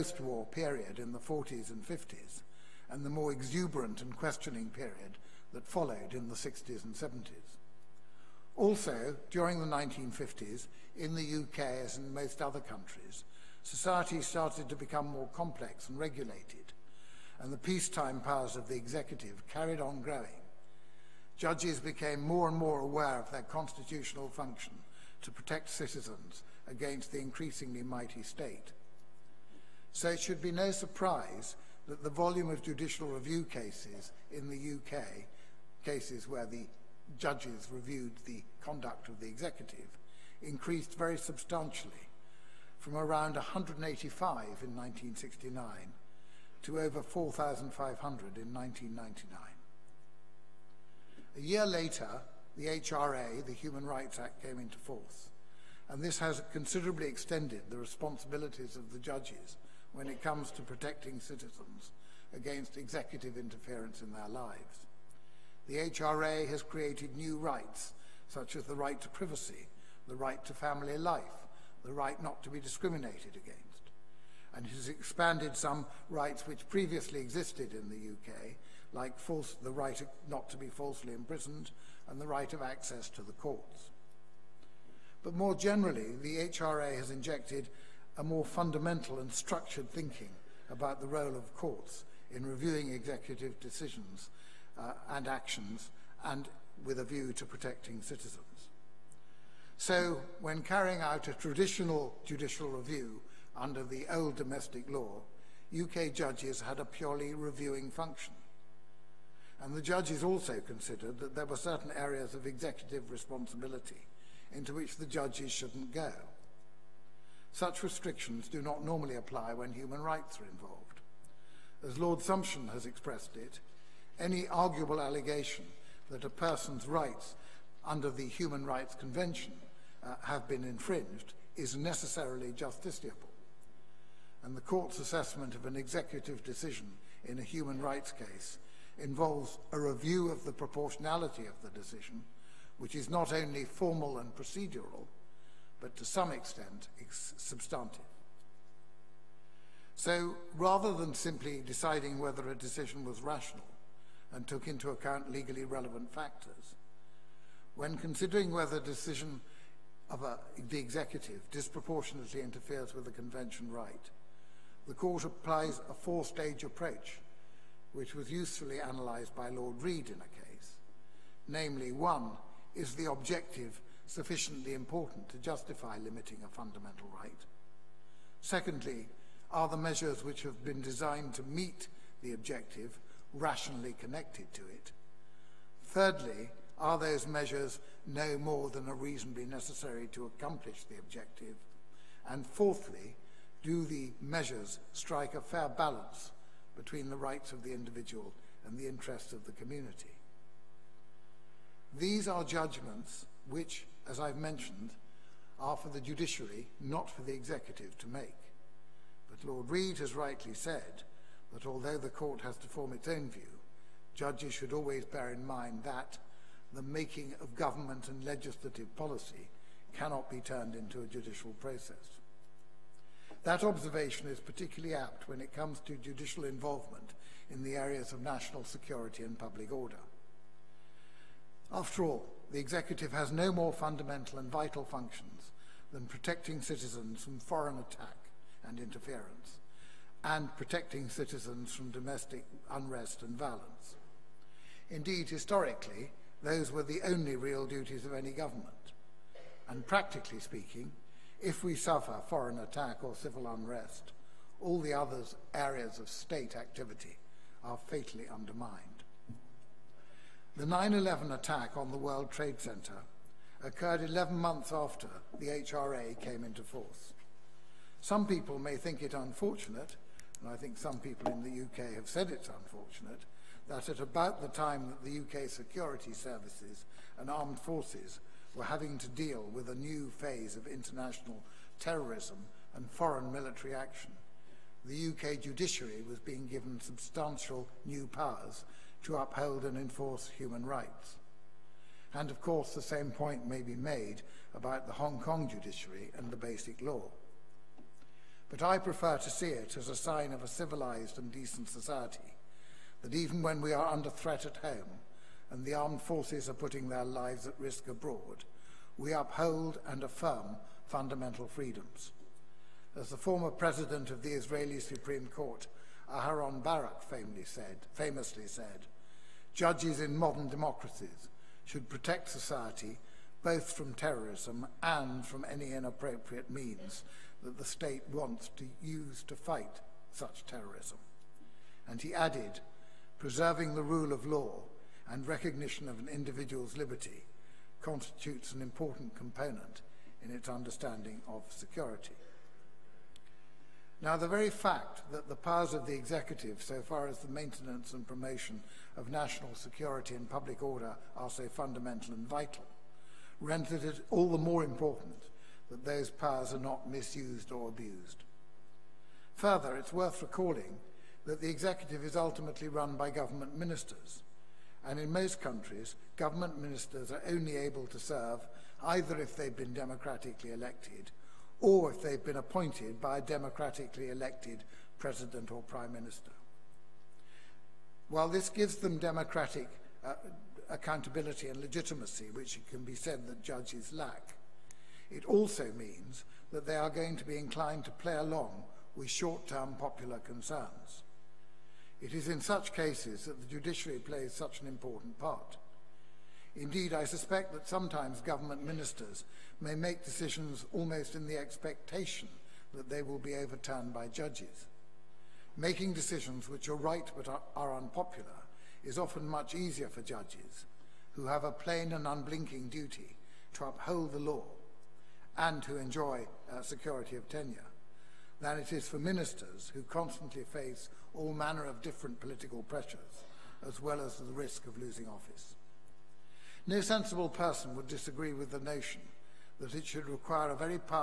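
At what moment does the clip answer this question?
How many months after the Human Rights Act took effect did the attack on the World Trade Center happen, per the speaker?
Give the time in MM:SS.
04:24.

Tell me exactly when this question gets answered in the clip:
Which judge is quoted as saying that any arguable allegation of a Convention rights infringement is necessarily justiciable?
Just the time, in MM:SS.
02:01.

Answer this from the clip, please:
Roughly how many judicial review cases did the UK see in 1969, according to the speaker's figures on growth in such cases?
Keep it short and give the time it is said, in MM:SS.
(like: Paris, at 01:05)
185, at 00:43.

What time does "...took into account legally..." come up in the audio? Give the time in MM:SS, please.
02:34.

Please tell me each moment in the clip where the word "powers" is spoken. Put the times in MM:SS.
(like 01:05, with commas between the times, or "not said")
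00:18, 04:48, 05:45, 05:56.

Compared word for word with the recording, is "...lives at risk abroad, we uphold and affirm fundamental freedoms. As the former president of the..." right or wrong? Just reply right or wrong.
right.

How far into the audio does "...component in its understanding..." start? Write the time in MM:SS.
05:39.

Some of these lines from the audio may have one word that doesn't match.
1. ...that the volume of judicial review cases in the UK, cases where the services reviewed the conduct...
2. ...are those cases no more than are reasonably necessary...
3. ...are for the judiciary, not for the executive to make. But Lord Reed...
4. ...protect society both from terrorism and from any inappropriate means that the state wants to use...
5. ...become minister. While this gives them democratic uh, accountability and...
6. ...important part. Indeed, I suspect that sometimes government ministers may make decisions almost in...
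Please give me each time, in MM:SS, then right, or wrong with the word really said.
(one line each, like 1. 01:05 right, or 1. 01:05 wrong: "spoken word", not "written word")
1. 00:31 wrong: "judges", not "services"
2. 03:06 wrong: "measures", not "cases"
3. 03:25 right
4. 05:21 right
5. 06:15 wrong: "prime", not "become"
6. 06:34 right.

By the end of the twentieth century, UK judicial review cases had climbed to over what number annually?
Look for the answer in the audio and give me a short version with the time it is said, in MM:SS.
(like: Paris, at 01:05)
4,500, at 00:47.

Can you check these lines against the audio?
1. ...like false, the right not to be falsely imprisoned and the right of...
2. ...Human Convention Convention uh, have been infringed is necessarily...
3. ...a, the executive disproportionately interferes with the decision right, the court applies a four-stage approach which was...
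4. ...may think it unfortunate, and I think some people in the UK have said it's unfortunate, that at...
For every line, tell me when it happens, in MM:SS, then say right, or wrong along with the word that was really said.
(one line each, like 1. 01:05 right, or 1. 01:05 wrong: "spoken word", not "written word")
1. 01:18 right
2. 02:08 wrong: "Rights", not "Convention"
3. 02:40 wrong: "convention", not "decision"
4. 04:28 right.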